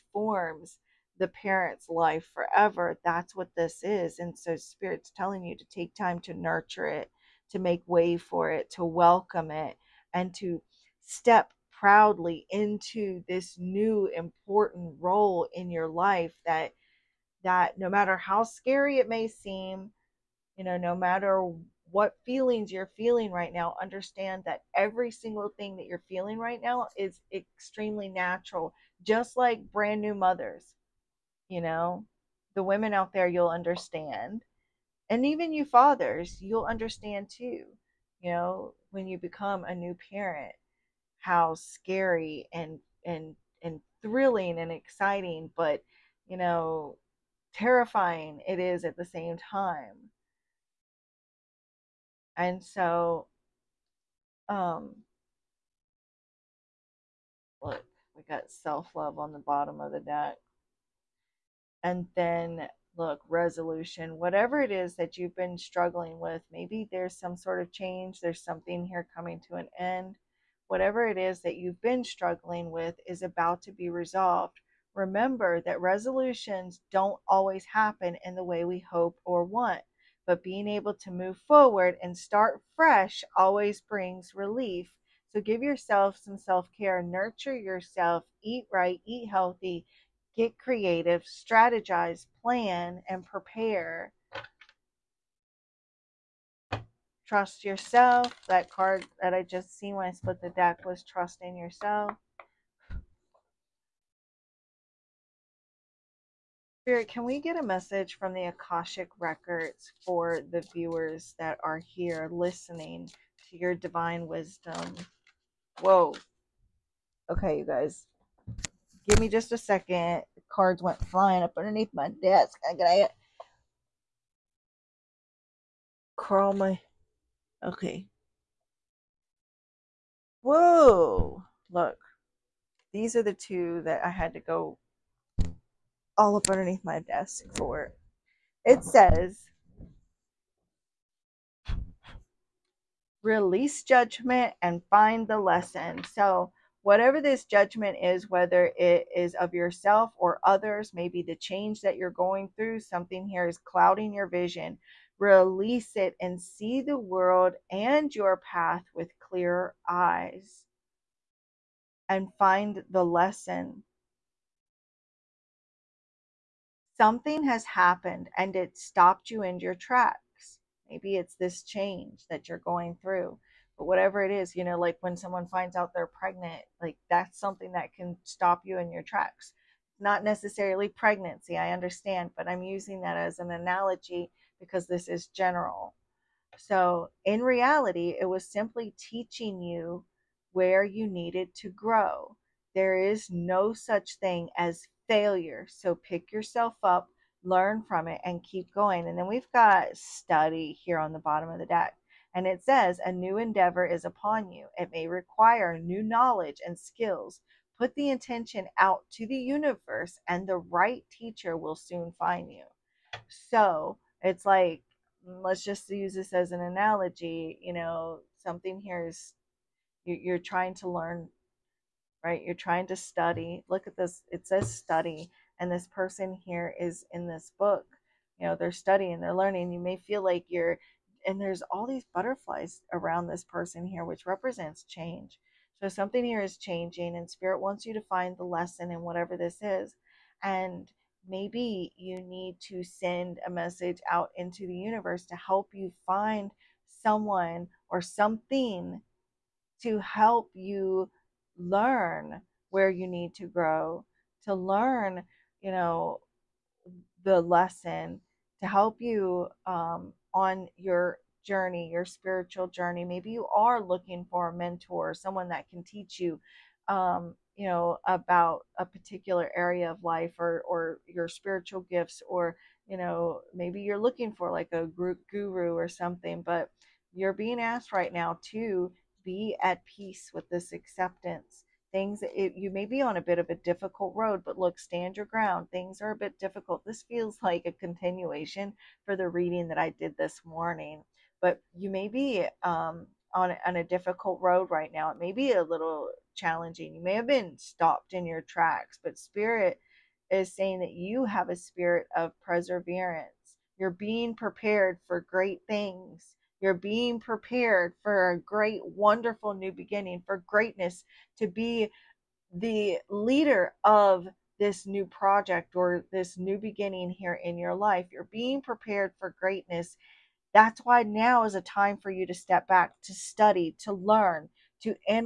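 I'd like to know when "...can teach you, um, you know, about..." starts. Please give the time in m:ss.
4:25.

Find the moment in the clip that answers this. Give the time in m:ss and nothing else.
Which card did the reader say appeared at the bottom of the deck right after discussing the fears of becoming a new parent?
0:58.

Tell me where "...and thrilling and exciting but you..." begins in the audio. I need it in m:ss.
0:43.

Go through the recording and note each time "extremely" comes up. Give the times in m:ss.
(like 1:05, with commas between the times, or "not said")
0:27.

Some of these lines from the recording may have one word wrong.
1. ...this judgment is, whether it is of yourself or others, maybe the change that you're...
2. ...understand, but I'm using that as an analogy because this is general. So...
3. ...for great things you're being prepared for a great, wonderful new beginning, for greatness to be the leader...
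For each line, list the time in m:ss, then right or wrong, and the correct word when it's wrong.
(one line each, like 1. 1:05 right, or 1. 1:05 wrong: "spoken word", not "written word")
1. 2:27 right
2. 3:01 right
3. 5:05 right.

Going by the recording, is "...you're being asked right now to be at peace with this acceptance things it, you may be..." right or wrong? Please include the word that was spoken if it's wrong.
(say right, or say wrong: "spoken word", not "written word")
right.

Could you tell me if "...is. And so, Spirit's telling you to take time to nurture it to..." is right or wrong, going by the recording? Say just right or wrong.
right.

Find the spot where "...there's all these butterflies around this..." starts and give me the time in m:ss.
3:51.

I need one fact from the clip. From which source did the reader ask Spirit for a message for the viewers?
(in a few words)
The Akashic Records.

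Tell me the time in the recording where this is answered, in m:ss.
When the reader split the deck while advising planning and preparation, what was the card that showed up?
1:41.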